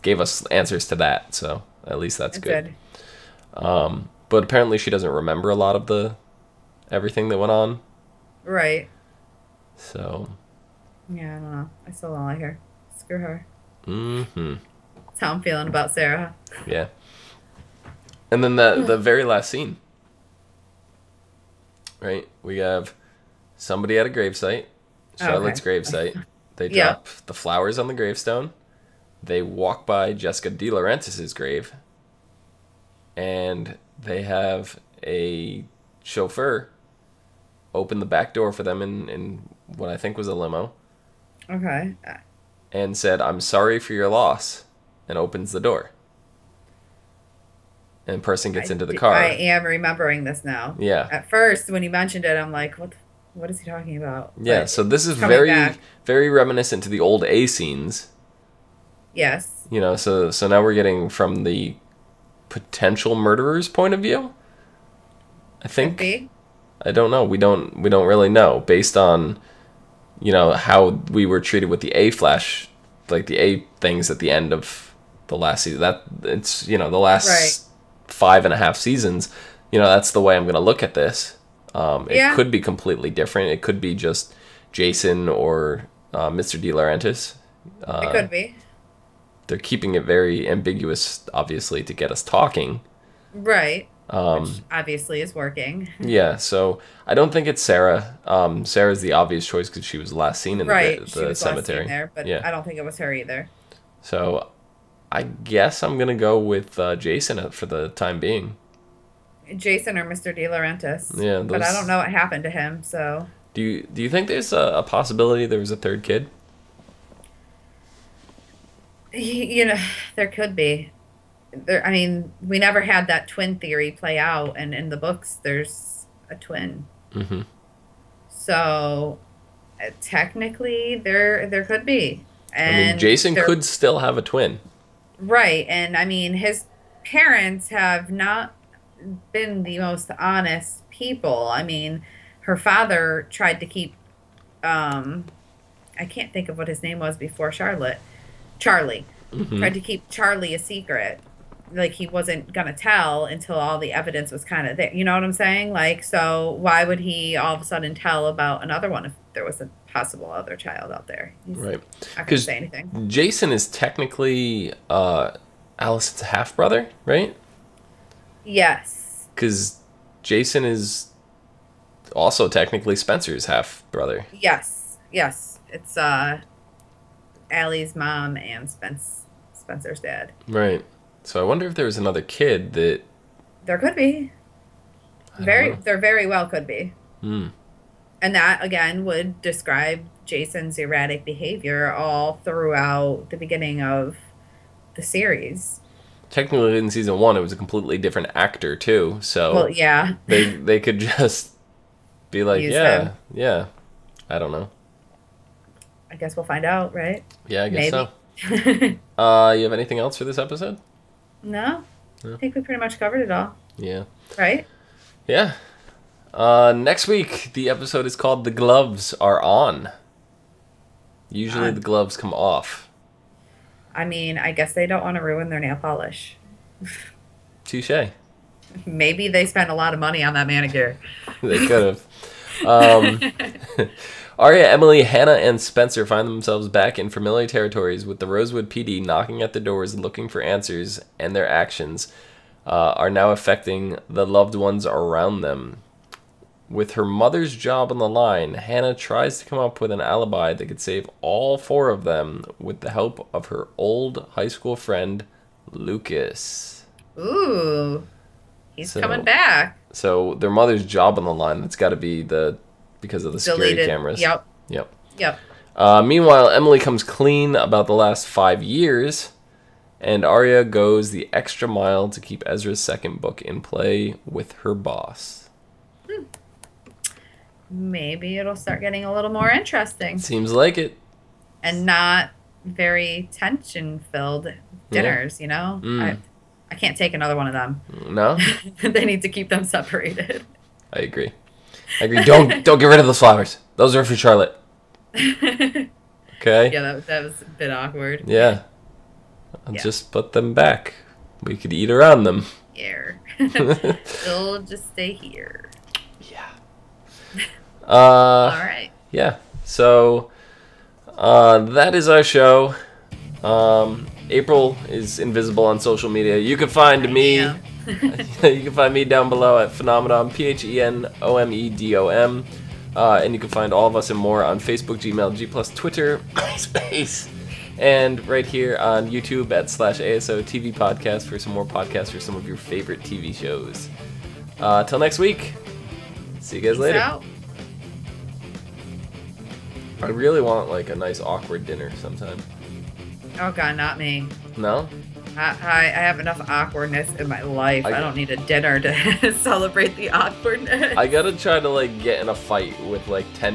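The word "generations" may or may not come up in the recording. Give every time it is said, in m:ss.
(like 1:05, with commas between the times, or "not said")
not said.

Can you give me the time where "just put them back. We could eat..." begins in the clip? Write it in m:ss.
4:59.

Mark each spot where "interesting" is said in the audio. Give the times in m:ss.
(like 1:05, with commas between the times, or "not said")
4:39.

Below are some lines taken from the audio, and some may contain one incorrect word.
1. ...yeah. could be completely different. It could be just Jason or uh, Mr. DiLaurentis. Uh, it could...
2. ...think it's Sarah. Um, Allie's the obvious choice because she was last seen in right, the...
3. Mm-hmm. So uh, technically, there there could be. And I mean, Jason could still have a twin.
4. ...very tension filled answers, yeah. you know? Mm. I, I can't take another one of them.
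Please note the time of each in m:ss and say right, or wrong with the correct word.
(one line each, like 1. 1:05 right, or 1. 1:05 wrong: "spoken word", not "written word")
1. 1:22 right
2. 1:37 wrong: "Sarah", not "Allie"
3. 2:07 right
4. 4:42 wrong: "dinners", not "answers".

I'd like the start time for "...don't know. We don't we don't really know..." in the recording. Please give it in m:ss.
1:06.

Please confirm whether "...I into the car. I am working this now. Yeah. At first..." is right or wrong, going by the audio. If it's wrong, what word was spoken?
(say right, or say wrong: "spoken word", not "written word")
wrong: "remembering", not "working".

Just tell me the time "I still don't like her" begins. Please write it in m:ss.
0:11.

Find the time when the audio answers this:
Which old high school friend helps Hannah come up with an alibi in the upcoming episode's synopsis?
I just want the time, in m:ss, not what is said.
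4:15.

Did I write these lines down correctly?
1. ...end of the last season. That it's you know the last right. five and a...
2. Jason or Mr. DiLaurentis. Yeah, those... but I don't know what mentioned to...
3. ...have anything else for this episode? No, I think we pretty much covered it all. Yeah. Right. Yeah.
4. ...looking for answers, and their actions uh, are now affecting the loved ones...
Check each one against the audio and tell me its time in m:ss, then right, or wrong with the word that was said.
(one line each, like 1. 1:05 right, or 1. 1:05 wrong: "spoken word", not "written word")
1. 1:14 right
2. 1:49 wrong: "happened", not "mentioned"
3. 3:29 right
4. 3:59 right.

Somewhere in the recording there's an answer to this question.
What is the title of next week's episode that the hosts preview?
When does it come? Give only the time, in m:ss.
3:38.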